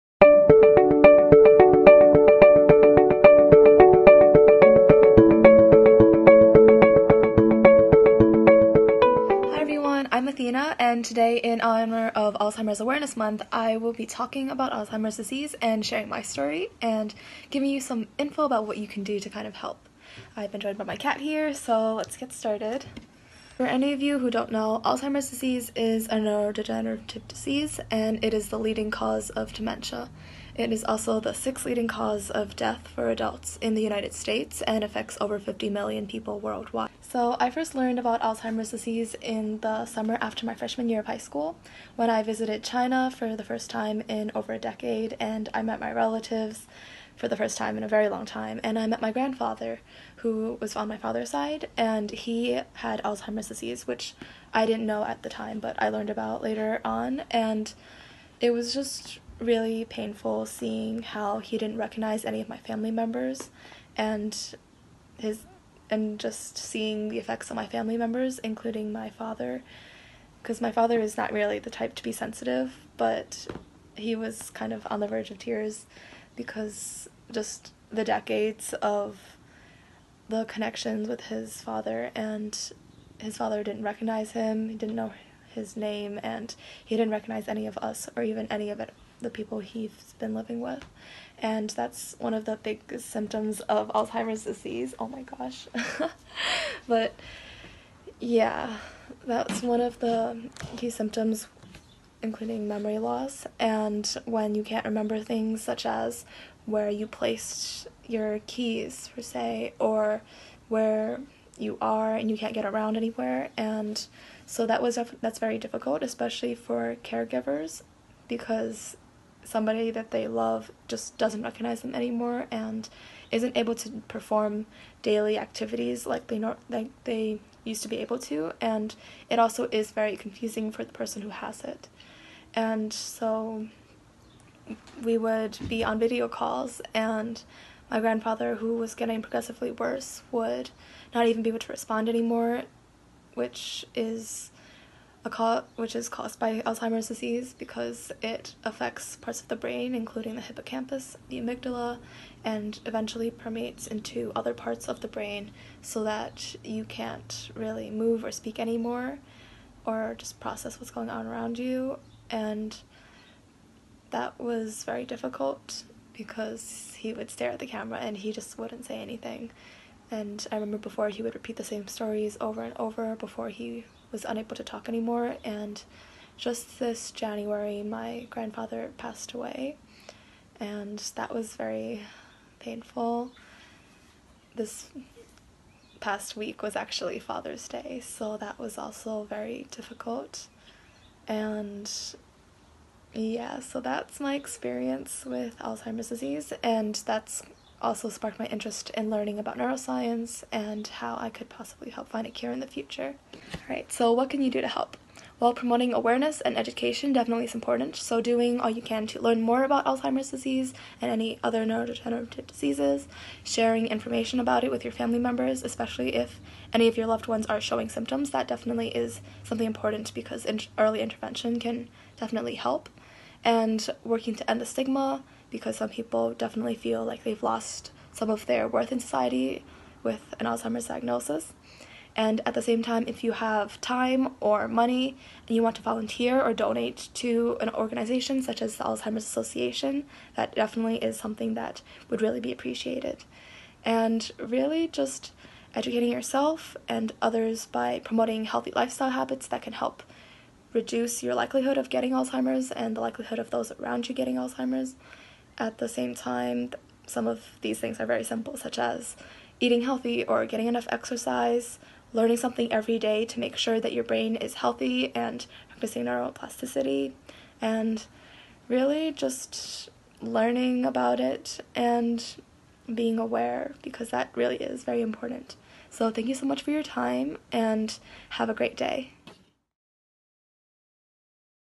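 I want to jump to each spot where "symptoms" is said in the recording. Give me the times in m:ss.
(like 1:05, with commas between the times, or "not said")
1:32, 1:40, 3:37.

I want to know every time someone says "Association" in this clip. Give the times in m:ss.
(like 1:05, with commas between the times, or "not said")
3:59.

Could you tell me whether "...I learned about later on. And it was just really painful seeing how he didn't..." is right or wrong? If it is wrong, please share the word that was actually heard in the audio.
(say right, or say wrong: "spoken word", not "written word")
right.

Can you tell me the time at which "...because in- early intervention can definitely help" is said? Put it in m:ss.
3:40.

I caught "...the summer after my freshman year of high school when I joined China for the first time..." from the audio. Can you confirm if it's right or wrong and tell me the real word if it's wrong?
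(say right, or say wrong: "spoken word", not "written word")
wrong: "visited", not "joined".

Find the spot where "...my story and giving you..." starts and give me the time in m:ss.
0:16.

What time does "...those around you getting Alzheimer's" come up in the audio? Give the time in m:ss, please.
4:13.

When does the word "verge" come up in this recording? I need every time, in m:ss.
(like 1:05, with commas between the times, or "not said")
1:15.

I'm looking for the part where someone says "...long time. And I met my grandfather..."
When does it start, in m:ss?
0:48.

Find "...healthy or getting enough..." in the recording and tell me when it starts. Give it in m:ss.
4:19.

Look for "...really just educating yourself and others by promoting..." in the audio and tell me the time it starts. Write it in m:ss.
4:04.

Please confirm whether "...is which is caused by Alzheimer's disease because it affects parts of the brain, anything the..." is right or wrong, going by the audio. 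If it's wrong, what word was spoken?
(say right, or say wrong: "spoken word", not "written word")
wrong: "including", not "anything".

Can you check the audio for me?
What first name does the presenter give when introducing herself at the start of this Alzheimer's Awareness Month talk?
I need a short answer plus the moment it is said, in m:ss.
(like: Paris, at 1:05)
Athena, at 0:10.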